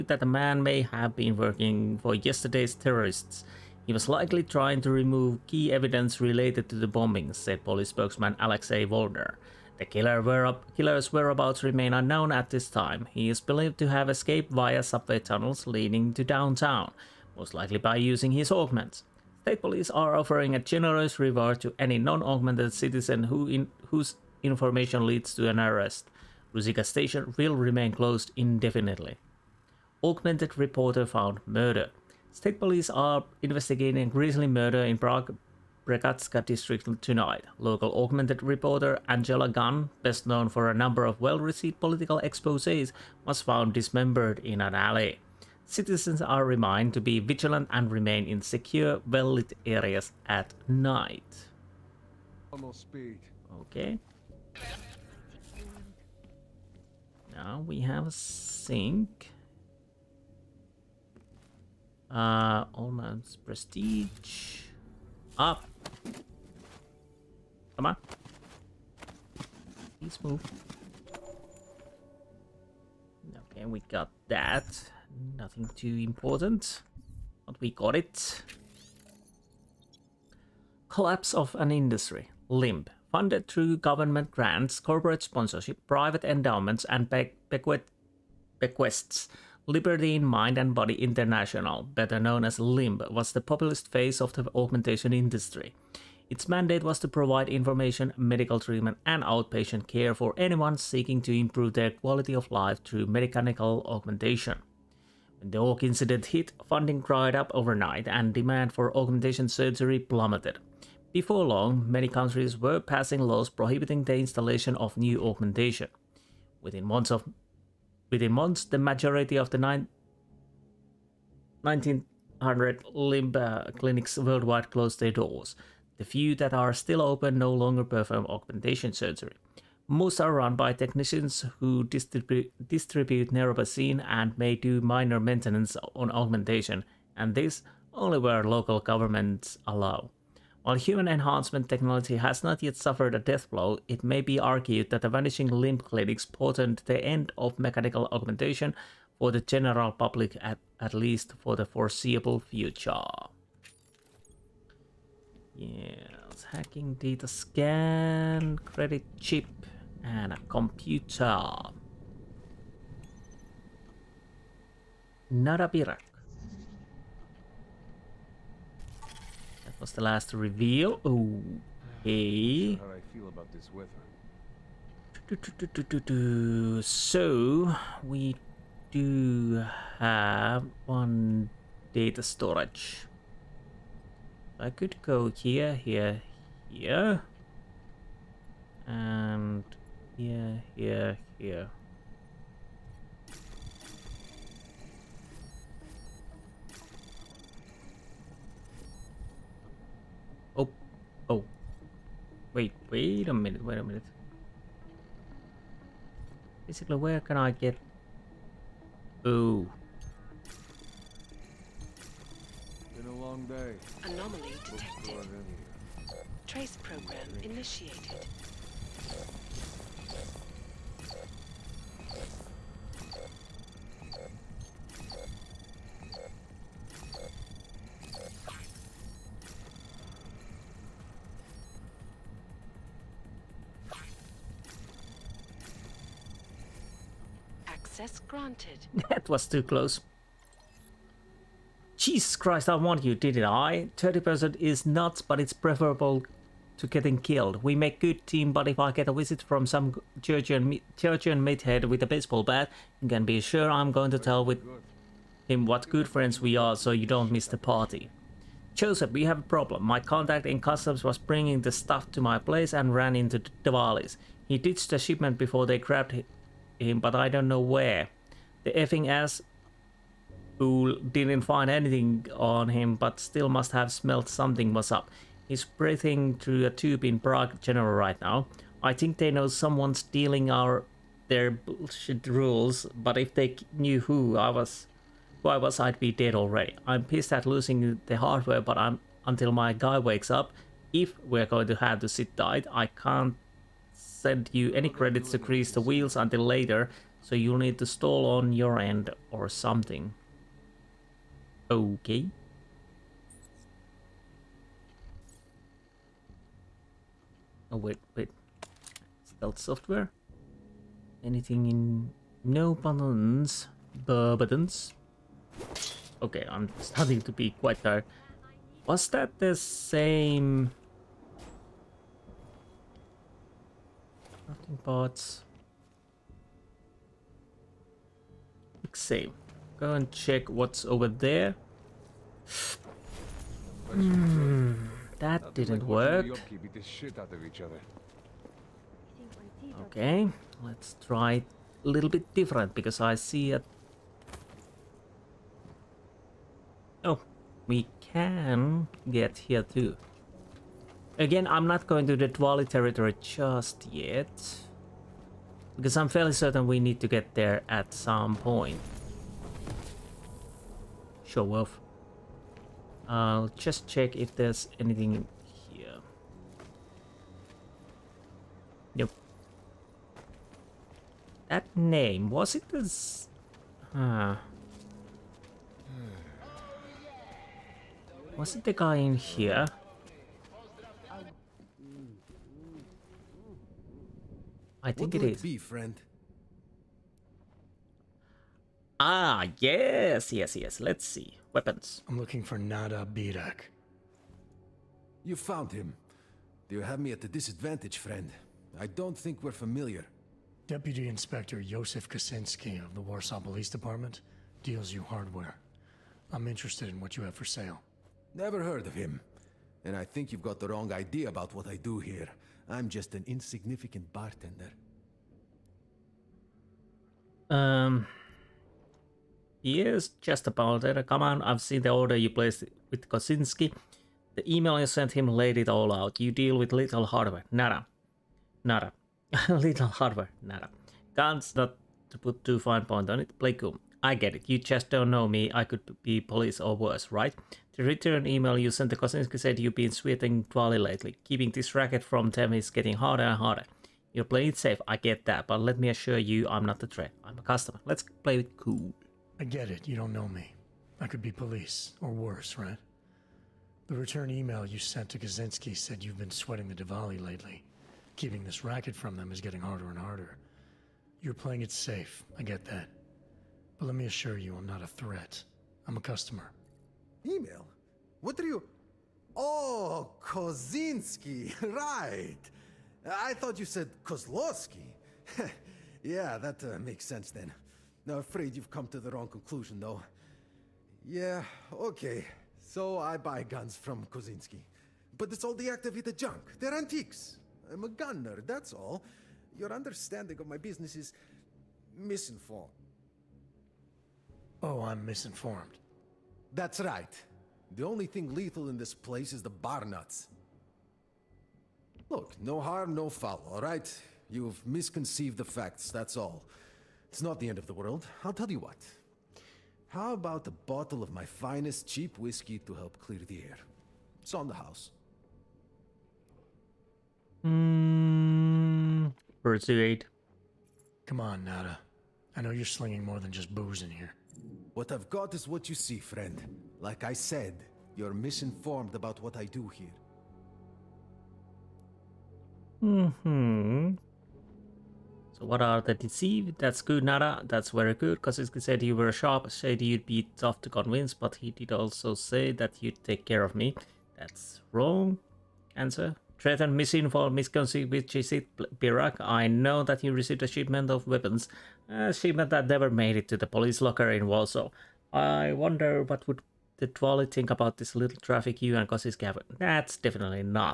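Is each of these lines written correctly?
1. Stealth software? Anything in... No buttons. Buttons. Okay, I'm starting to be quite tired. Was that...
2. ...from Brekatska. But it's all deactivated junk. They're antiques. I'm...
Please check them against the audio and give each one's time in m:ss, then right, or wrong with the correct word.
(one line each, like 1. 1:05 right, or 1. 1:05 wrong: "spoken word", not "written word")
1. 5:09 right
2. 8:03 wrong: "Kozinski", not "Brekatska".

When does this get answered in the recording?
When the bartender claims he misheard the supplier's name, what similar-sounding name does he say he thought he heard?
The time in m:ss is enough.
7:54.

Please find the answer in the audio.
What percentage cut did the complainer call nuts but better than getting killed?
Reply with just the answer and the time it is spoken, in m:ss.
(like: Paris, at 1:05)
30%, at 4:03.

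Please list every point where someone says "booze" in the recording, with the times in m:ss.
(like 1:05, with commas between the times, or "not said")
8:43.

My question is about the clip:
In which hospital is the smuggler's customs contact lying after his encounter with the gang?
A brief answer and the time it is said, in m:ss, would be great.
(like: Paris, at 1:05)
Prague General, at 4:37.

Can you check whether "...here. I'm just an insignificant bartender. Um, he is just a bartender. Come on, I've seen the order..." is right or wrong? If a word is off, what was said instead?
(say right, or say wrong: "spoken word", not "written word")
right.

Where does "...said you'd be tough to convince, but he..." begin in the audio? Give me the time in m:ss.
8:59.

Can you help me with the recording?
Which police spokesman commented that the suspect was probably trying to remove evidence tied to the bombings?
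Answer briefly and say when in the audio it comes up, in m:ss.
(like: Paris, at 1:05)
Alexei Volner, at 0:08.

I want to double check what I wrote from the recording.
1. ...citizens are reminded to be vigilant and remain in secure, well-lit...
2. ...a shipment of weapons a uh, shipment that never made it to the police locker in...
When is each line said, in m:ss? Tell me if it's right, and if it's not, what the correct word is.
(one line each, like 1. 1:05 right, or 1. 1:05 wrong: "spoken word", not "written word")
1. 0:45 right
2. 9:10 right.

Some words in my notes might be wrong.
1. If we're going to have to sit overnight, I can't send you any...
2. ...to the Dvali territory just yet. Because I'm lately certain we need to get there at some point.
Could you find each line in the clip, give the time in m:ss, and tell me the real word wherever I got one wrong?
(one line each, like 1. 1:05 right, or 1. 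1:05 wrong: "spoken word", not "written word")
1. 4:50 wrong: "tight", not "overnight"
2. 5:52 wrong: "fairly", not "lately".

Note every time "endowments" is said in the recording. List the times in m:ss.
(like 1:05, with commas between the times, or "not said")
1:26.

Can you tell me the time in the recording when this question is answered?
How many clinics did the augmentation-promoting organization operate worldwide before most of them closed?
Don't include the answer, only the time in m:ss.
1:59.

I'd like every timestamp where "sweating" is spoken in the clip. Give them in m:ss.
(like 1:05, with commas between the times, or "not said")
7:19, 7:36.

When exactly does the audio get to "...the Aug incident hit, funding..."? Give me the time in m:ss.
1:45.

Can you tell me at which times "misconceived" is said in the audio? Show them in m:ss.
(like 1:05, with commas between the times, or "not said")
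8:24, 9:07.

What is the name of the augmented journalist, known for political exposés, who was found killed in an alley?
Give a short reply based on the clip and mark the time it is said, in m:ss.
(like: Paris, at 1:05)
Angela Gunn, at 0:39.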